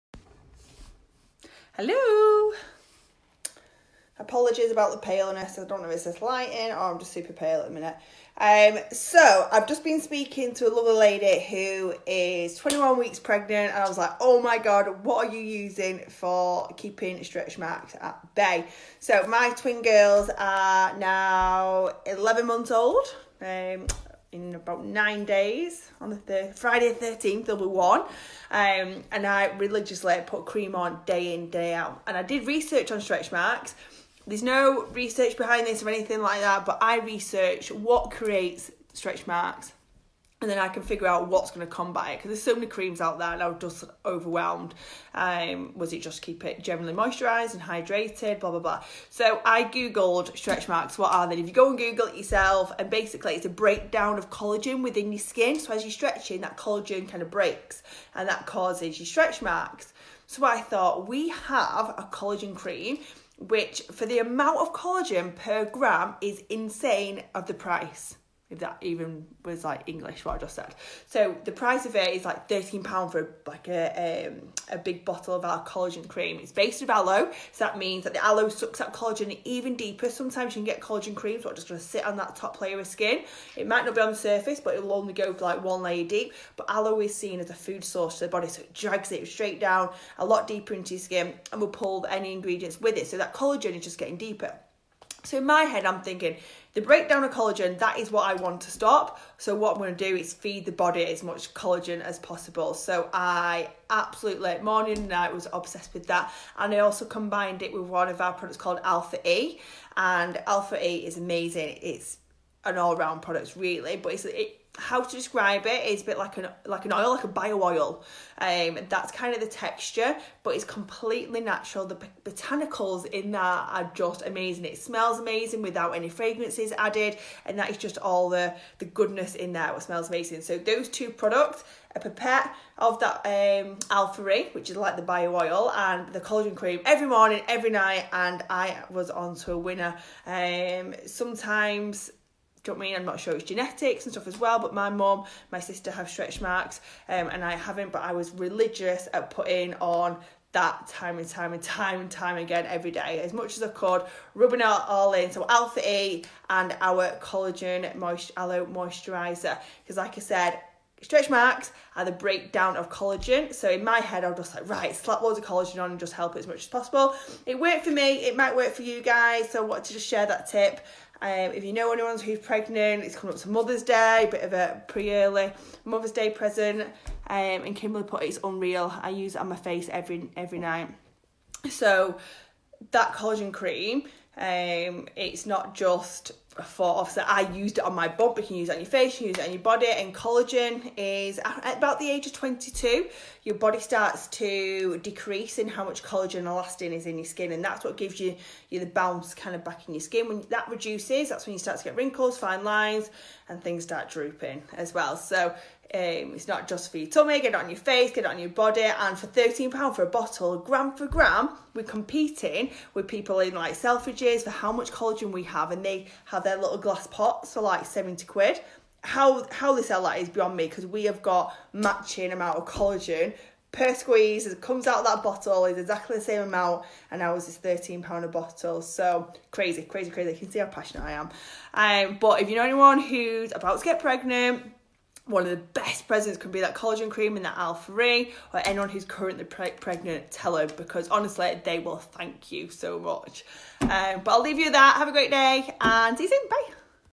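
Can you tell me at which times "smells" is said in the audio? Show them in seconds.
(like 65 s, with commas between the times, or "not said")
124 s, 129 s.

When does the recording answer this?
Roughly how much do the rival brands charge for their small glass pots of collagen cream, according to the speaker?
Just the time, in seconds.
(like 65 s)
217 s.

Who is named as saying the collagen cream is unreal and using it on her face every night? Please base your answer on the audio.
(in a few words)
Kimberly.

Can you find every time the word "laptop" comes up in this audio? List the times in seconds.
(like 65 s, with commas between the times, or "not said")
not said.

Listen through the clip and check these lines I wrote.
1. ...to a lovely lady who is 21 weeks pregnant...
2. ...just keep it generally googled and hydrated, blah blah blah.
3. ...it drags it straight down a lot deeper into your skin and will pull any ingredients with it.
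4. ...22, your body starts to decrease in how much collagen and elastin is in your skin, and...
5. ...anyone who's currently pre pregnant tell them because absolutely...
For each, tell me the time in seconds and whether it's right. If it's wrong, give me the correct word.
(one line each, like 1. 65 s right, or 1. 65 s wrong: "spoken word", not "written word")
1. 10 s right
2. 46 s wrong: "moisturised", not "googled"
3. 88 s right
4. 192 s right
5. 238 s wrong: "honestly", not "absolutely".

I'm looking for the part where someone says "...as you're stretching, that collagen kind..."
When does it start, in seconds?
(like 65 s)
55 s.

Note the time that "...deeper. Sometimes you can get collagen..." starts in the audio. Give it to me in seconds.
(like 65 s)
79 s.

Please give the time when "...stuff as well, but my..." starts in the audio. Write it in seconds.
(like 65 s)
144 s.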